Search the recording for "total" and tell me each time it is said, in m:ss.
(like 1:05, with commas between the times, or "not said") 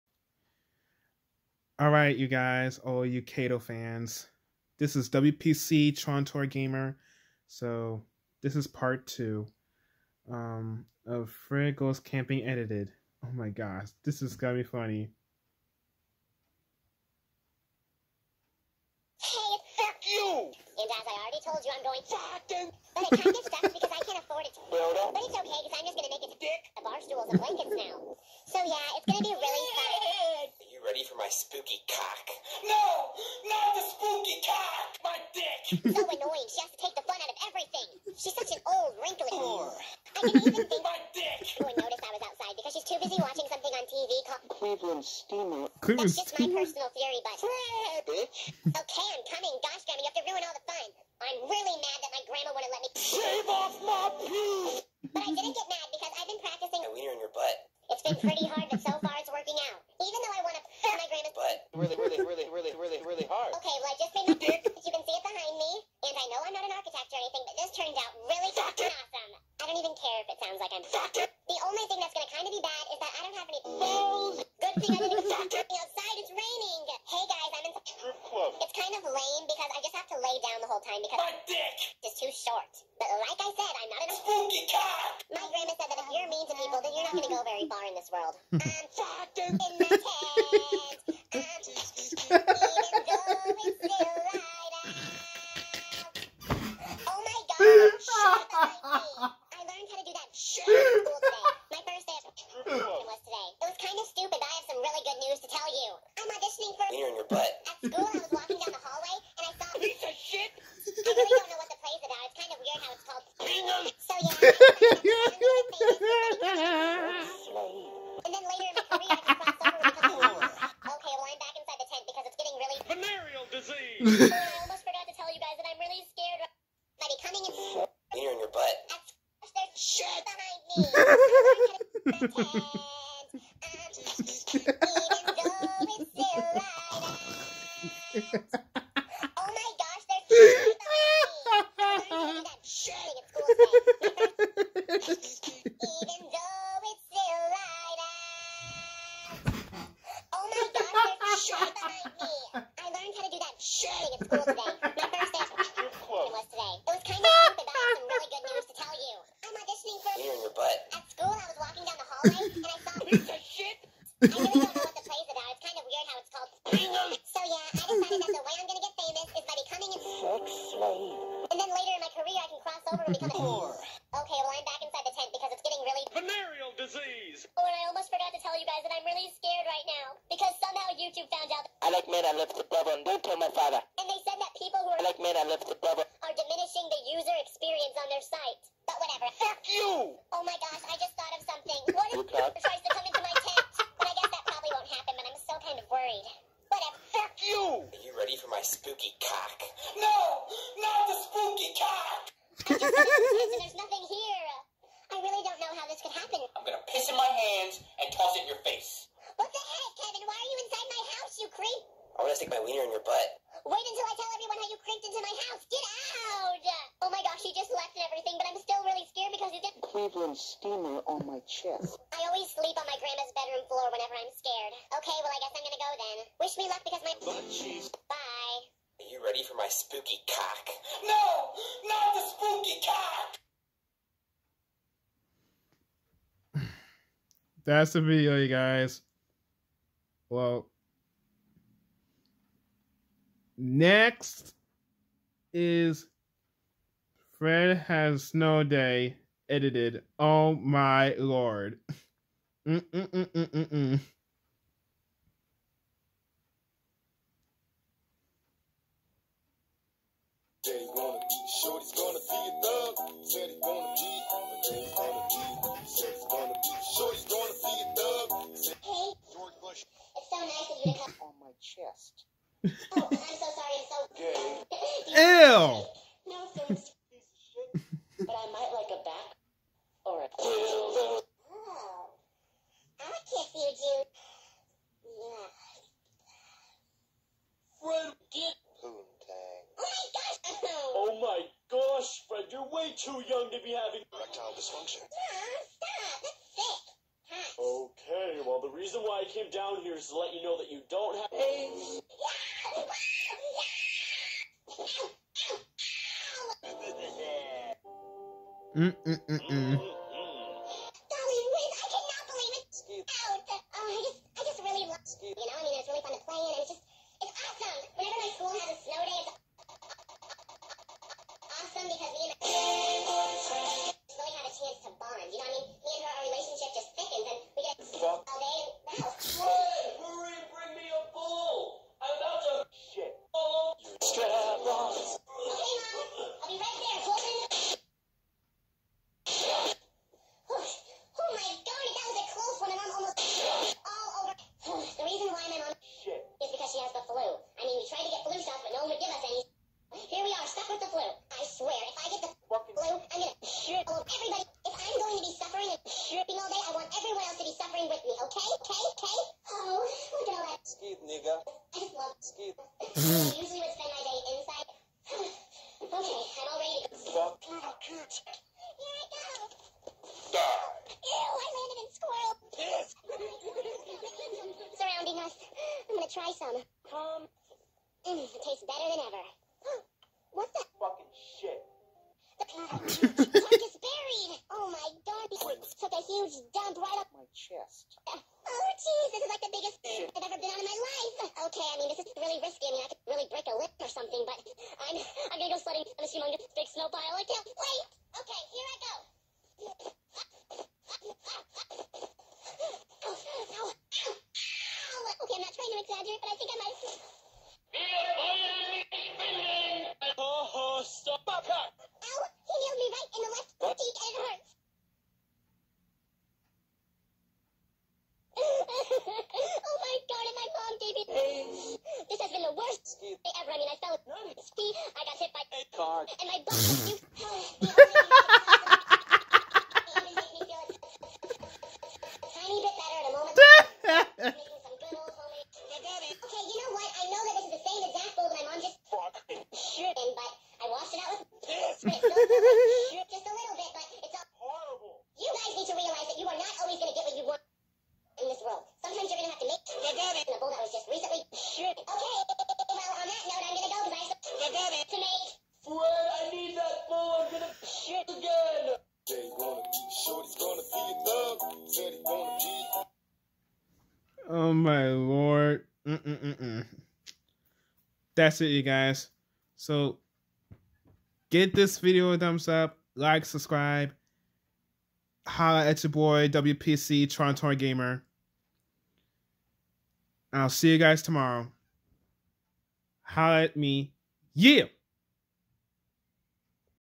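not said.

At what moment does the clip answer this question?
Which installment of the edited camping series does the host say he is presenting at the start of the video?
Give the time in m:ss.
0:08.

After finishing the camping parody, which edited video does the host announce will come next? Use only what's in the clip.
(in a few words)
Fred Has Snow Day.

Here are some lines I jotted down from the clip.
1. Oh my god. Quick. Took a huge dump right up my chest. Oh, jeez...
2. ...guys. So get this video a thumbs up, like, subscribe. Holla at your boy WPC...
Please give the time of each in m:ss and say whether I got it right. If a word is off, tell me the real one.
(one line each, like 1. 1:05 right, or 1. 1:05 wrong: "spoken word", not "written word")
1. 6:24 right
2. 7:48 right.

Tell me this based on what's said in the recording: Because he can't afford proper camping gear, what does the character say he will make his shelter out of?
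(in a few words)
A barstool and blankets.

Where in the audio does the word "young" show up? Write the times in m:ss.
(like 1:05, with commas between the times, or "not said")
4:53.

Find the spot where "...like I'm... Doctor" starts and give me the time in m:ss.
1:10.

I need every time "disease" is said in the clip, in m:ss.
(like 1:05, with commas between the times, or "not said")
2:03, 2:56.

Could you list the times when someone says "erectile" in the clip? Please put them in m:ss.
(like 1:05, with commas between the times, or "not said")
4:54.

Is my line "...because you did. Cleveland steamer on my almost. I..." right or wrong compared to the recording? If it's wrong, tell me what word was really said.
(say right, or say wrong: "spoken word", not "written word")
wrong: "chest", not "almost".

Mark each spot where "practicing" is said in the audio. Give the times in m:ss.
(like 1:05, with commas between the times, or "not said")
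0:56.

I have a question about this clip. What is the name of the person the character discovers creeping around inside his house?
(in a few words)
Kevin.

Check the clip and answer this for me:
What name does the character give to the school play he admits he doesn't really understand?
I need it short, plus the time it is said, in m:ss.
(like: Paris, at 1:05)
Bingham, at 1:53.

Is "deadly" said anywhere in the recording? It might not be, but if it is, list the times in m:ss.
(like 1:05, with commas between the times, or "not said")
not said.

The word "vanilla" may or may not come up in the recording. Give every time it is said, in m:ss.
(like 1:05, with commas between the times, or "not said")
not said.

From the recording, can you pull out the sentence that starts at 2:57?
Oh, and I almost forgot to tell you guys that I'm really scared right now.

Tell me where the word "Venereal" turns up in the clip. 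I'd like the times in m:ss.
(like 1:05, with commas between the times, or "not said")
2:02, 2:56.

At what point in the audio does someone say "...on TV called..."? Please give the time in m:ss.
0:43.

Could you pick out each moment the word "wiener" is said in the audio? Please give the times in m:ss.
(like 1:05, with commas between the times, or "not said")
0:56, 3:32.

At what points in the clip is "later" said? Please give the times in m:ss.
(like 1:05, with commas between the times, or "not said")
1:58, 2:51.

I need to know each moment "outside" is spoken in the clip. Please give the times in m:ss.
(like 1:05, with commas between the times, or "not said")
0:42, 1:15.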